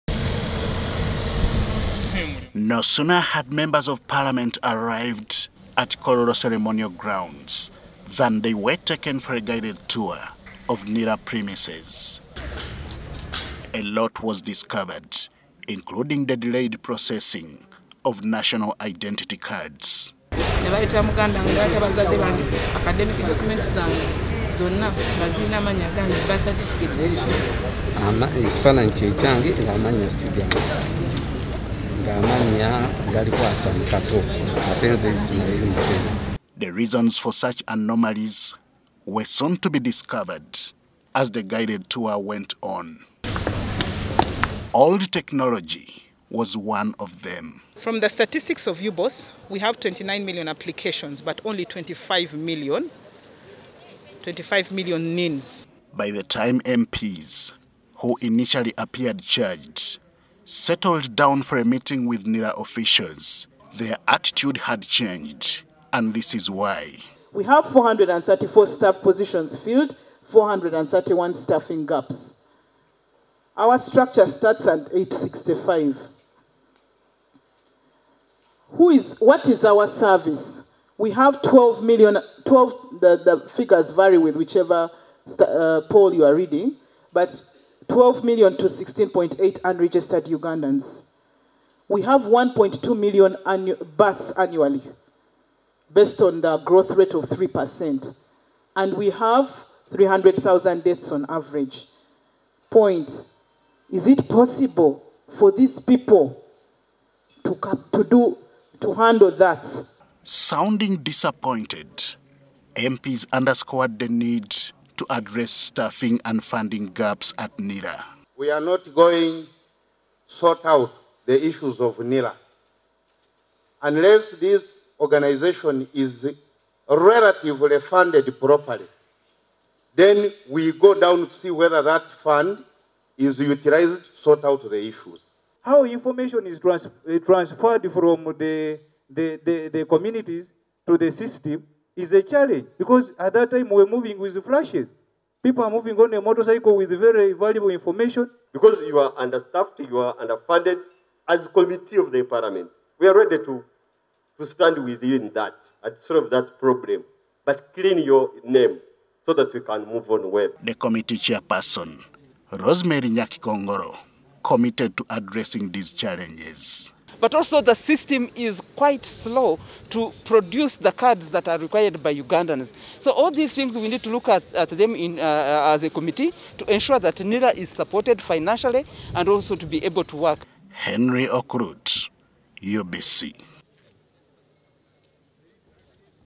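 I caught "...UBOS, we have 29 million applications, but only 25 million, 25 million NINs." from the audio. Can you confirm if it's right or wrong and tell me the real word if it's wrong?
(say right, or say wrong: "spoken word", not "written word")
right.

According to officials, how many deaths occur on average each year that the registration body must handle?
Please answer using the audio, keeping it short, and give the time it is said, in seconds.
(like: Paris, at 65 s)
300,000, at 99 s.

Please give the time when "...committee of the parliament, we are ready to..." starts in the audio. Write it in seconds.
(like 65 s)
151 s.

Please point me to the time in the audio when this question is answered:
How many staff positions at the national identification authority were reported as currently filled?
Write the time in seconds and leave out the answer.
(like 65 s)
67 s.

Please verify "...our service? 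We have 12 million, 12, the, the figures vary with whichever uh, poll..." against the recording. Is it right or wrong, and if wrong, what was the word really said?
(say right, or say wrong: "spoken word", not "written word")
right.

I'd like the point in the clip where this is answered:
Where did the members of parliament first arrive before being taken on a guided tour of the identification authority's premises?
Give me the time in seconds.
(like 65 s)
6 s.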